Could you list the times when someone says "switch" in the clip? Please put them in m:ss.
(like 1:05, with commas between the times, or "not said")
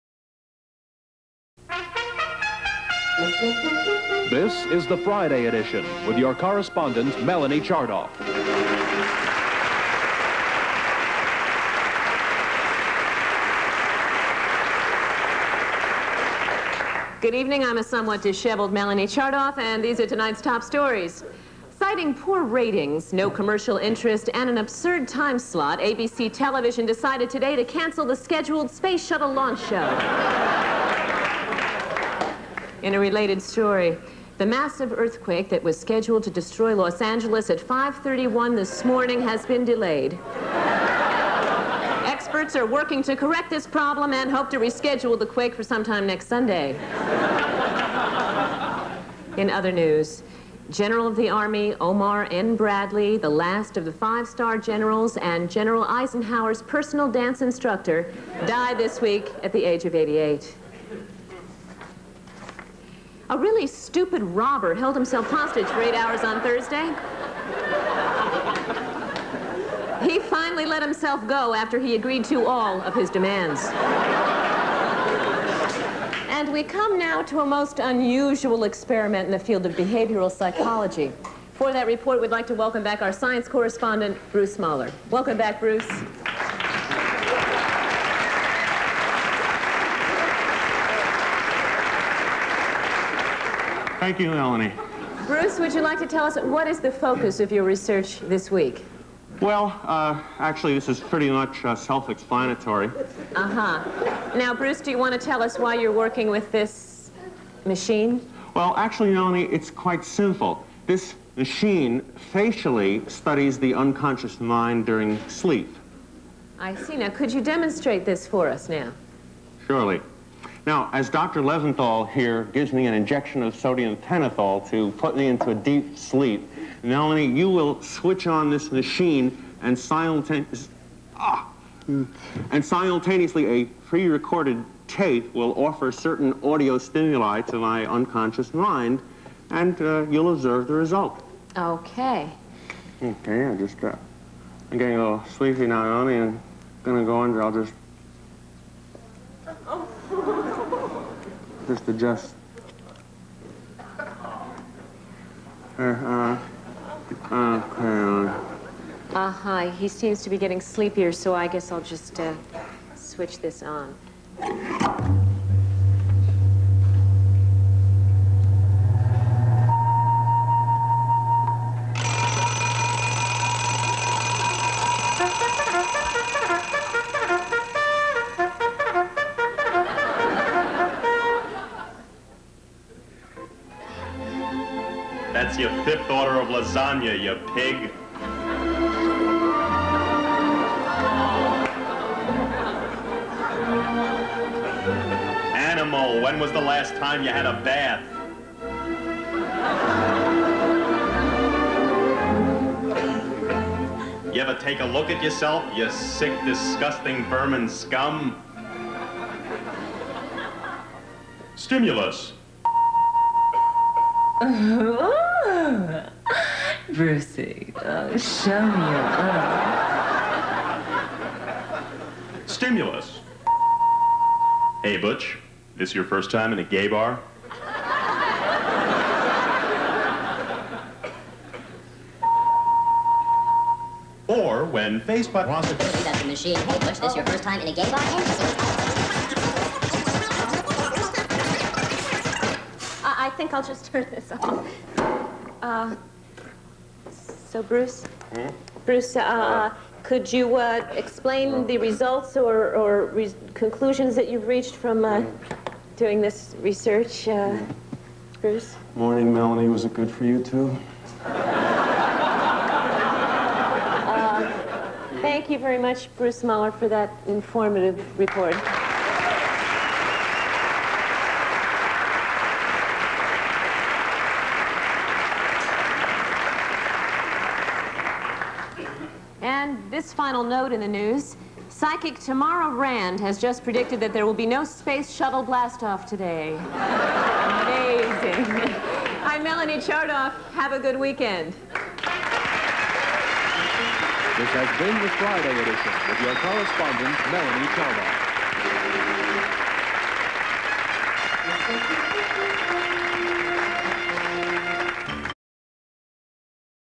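2:07, 2:42.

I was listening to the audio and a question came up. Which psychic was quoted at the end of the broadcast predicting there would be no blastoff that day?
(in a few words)
Tamara Rand.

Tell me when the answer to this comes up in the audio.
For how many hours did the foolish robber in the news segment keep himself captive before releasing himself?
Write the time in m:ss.
1:05.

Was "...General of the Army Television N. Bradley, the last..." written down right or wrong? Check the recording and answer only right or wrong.
wrong.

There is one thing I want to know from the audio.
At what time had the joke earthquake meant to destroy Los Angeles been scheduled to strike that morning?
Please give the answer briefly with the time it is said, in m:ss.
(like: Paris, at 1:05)
5:31, at 0:37.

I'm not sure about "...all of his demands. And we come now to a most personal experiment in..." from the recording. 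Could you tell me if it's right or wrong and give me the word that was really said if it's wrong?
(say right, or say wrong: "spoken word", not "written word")
wrong: "unusual", not "personal".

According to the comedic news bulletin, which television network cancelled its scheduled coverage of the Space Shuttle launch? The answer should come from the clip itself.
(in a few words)
ABC.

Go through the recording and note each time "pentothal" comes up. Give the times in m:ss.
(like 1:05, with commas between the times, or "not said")
2:03.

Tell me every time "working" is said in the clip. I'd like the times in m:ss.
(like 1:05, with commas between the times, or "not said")
0:42, 1:45.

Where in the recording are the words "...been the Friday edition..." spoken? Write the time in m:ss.
4:54.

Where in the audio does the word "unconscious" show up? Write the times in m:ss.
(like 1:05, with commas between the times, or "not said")
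1:53, 2:17.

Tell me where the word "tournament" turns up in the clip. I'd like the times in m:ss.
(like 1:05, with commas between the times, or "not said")
not said.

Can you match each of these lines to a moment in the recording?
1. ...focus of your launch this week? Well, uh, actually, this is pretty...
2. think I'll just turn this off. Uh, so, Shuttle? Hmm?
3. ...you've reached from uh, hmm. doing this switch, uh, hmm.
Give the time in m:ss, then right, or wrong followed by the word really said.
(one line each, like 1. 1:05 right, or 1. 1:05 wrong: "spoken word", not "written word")
1. 1:36 wrong: "research", not "launch"
2. 4:03 wrong: "Bruce", not "Shuttle"
3. 4:14 wrong: "research", not "switch".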